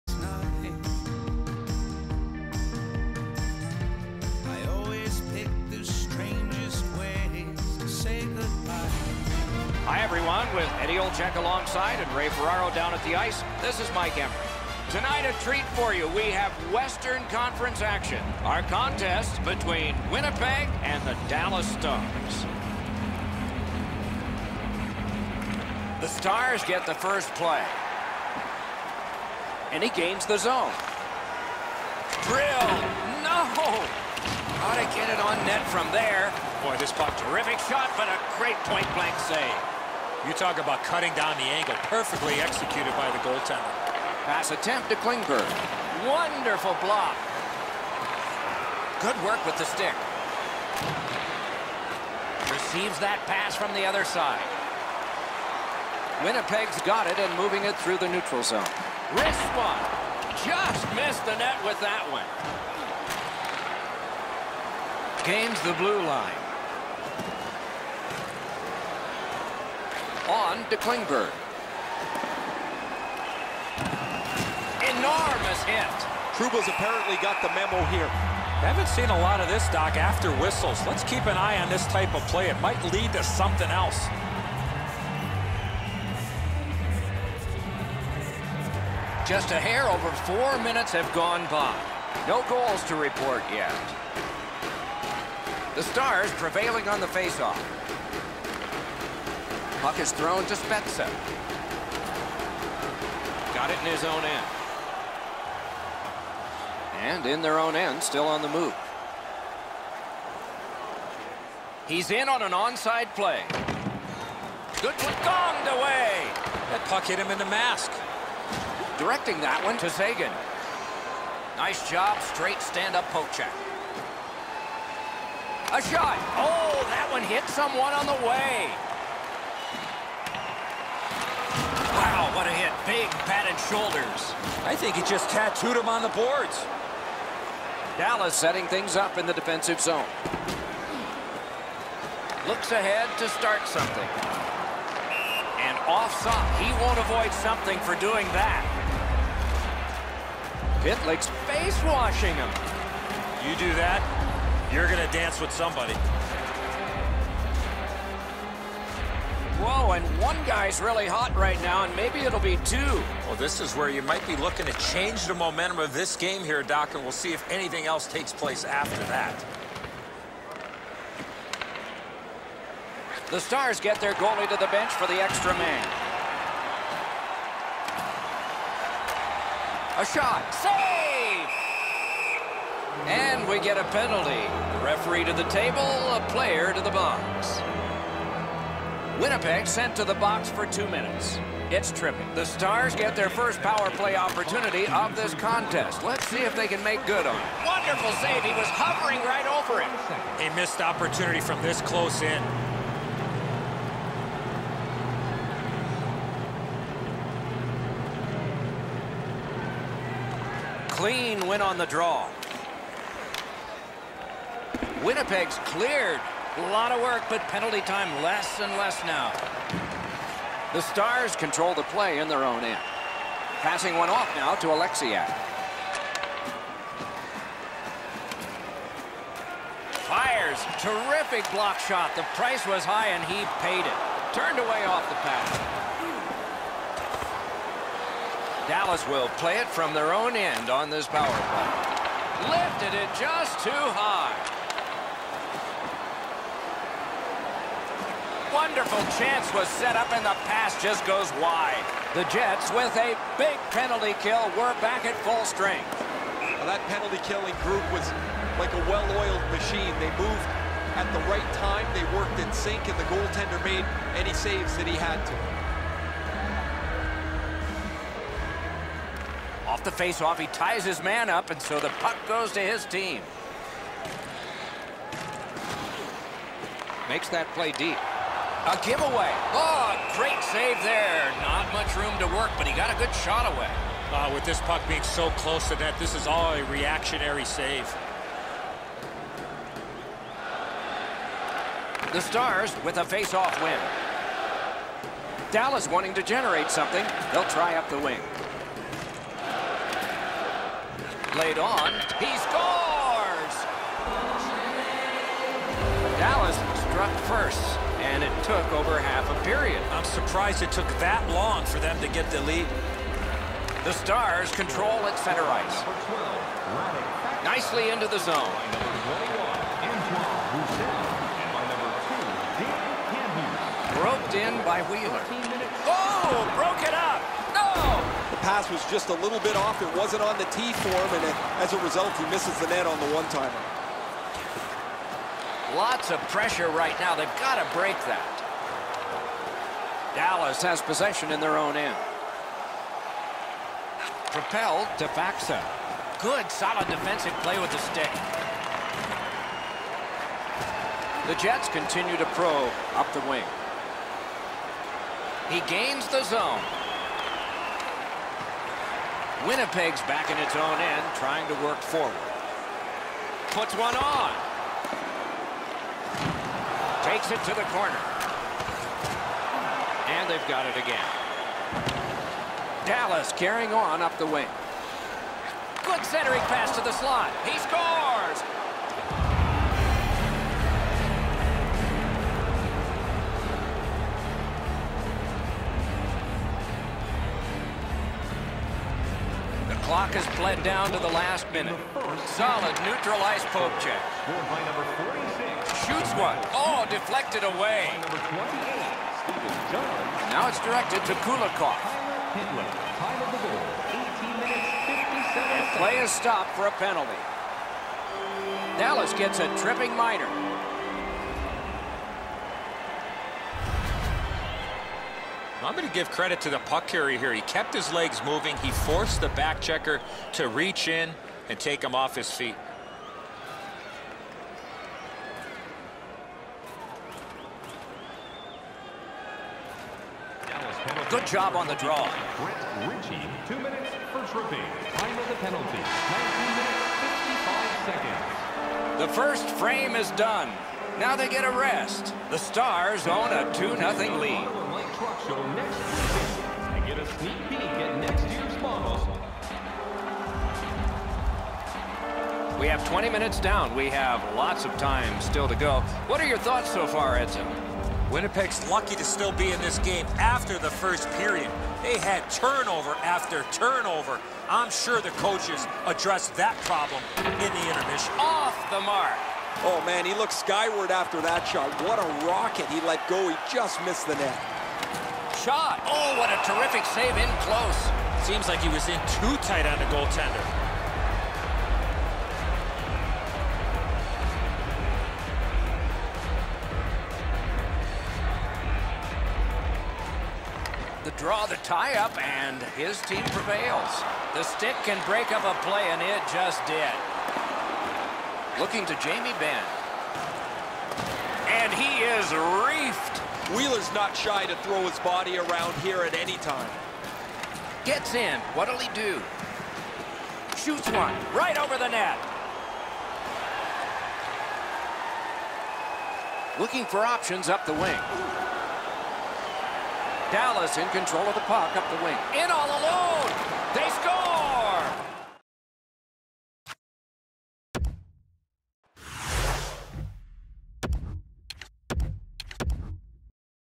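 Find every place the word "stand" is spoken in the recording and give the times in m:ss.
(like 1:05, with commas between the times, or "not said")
2:02.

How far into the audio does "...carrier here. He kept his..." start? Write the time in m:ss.
6:56.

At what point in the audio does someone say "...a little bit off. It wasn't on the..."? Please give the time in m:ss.
5:29.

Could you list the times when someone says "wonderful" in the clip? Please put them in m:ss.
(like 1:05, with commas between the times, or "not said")
0:46, 3:17, 4:08.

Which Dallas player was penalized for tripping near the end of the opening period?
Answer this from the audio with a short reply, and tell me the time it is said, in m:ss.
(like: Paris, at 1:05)
Brett Ritchie, at 7:12.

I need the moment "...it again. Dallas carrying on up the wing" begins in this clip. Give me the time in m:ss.
6:10.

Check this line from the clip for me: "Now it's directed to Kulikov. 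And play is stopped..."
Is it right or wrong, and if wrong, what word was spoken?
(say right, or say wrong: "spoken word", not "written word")
right.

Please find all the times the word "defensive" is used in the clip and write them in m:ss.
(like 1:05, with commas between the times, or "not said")
2:19, 5:46.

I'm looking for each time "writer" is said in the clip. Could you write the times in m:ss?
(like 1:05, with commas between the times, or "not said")
not said.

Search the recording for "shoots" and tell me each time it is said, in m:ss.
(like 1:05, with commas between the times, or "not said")
6:35, 8:30.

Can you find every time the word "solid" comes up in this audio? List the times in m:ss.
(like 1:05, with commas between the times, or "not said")
5:46, 6:32.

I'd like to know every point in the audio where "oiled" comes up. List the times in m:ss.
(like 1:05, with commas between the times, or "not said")
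4:18.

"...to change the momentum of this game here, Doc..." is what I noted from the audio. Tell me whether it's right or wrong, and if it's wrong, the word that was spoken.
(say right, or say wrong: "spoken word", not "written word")
right.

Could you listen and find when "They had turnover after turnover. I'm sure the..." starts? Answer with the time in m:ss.
7:41.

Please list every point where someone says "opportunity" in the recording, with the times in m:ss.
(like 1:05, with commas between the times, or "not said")
3:14, 3:20.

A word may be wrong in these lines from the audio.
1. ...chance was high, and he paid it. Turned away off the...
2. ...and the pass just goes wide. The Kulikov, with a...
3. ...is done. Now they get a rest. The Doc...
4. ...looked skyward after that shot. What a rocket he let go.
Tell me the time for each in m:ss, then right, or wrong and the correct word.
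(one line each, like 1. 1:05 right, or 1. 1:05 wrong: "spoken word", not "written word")
1. 3:52 wrong: "price", not "chance"
2. 4:10 wrong: "Jets", not "Kulikov"
3. 7:19 wrong: "Stars", not "Doc"
4. 7:50 right.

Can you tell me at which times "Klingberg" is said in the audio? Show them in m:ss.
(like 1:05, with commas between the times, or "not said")
0:44, 1:10.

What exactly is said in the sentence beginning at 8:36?
Looking for options up the wing.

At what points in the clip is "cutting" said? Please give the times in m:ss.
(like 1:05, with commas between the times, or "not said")
0:40.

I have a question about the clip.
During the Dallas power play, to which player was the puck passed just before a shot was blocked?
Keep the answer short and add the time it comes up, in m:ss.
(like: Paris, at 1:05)
Oleksiak, at 3:44.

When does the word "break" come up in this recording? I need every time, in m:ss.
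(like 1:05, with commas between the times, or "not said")
5:37, 8:15.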